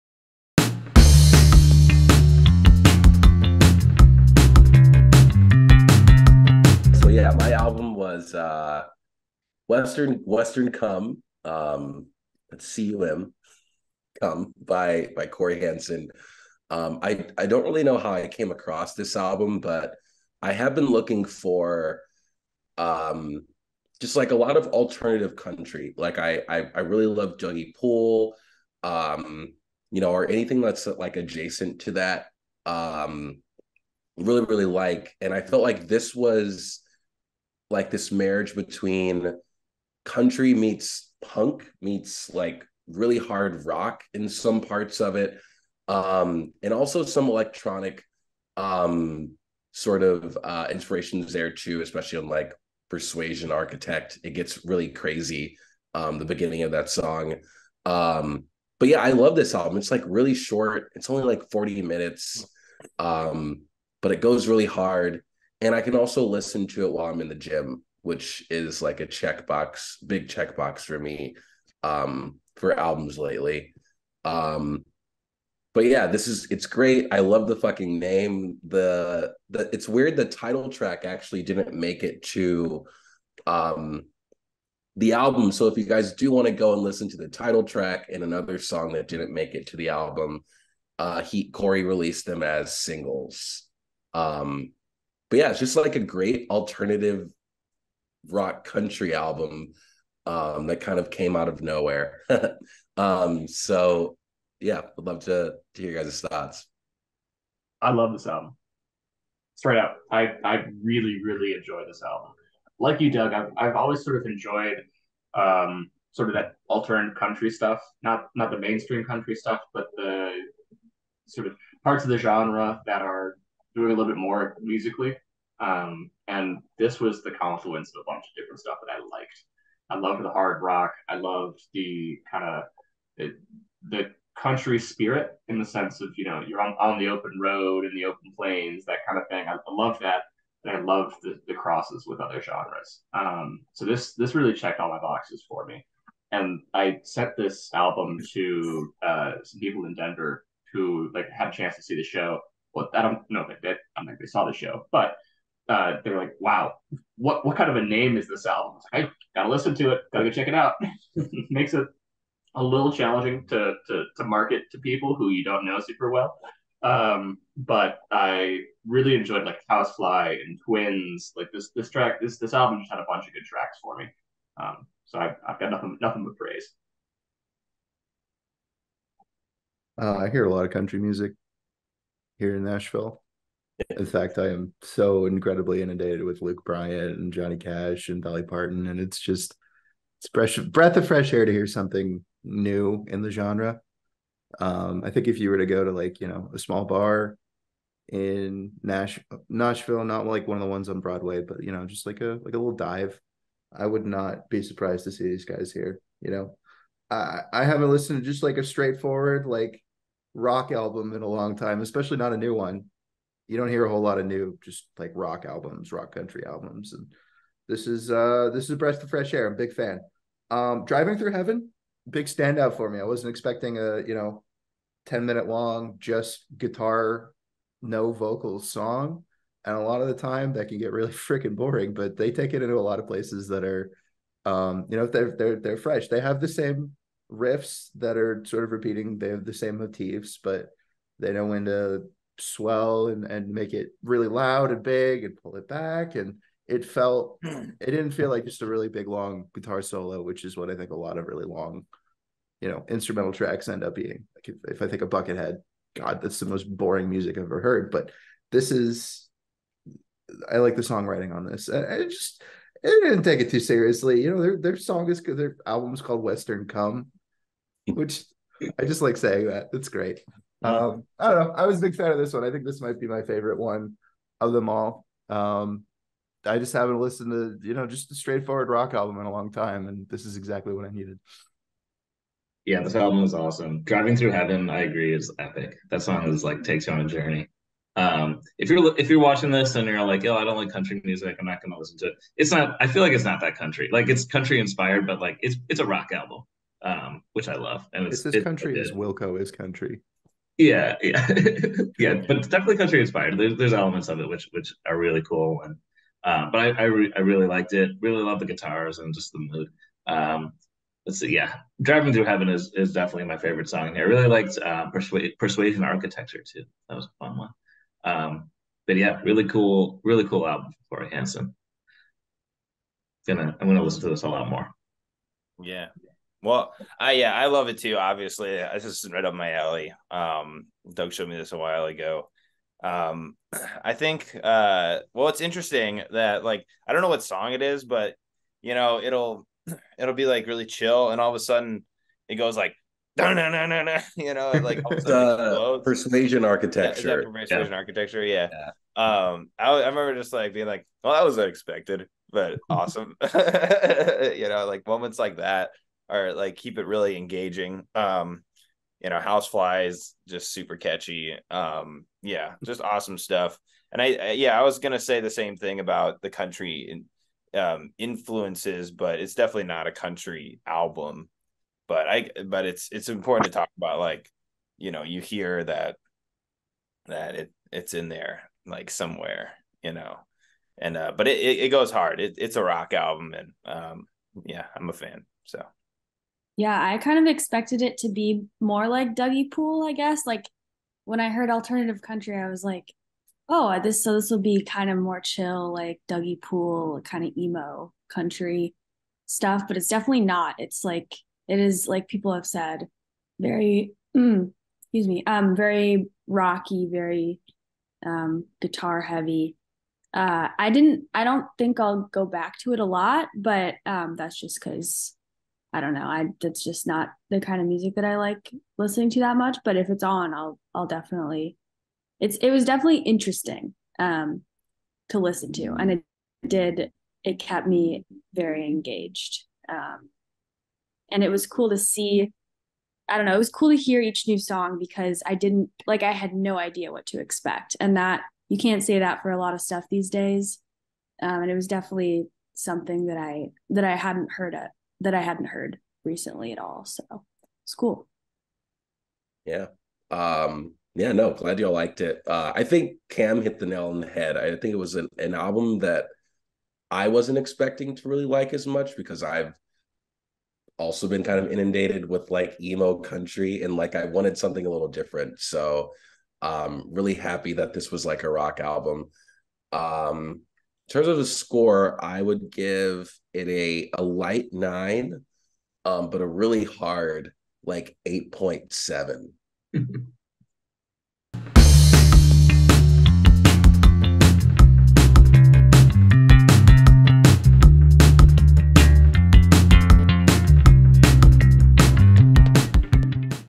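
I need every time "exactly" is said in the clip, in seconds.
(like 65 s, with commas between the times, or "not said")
280 s.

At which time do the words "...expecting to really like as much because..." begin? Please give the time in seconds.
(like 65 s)
457 s.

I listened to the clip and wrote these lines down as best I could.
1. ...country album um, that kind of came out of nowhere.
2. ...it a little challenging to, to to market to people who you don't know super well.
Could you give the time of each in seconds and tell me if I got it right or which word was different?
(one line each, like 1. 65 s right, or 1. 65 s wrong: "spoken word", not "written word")
1. 98 s right
2. 161 s right.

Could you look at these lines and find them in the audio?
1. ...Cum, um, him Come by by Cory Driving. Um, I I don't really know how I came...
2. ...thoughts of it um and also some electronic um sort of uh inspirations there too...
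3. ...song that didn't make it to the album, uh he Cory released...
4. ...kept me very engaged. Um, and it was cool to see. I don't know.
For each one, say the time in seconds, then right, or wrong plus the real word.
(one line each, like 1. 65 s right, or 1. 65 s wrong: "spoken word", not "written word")
1. 10 s wrong: "Hanson", not "Driving"
2. 44 s wrong: "parts", not "thoughts"
3. 88 s right
4. 427 s right.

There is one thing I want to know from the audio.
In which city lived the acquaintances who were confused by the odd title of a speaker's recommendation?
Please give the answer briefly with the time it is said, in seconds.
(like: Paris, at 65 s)
Denver, at 149 s.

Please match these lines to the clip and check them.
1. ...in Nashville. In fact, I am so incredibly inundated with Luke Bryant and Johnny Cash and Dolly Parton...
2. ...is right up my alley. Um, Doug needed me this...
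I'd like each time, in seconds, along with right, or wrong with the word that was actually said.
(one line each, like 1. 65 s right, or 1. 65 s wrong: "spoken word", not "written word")
1. 182 s right
2. 328 s wrong: "showed", not "needed".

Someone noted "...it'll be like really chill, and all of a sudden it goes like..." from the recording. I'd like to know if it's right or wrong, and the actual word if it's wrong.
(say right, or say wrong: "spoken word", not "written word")
right.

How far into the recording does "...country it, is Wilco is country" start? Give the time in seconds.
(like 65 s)
298 s.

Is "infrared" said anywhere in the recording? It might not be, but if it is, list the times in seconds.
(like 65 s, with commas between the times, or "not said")
not said.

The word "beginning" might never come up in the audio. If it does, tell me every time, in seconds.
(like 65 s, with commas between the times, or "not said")
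56 s.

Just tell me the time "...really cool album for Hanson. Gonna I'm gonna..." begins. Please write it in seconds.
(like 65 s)
320 s.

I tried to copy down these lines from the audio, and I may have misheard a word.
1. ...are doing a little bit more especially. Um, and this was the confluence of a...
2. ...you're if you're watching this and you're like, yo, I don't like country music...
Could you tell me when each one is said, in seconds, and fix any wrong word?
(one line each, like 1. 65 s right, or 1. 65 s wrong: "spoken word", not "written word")
1. 123 s wrong: "musically", not "especially"
2. 288 s right.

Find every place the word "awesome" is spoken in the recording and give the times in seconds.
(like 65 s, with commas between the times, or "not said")
283 s, 352 s, 362 s.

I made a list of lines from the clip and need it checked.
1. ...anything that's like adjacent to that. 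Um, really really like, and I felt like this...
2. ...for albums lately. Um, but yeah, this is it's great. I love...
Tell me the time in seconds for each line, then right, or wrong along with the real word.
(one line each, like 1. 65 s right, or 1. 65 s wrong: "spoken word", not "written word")
1. 30 s right
2. 72 s right.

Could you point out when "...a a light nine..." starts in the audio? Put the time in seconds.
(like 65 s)
473 s.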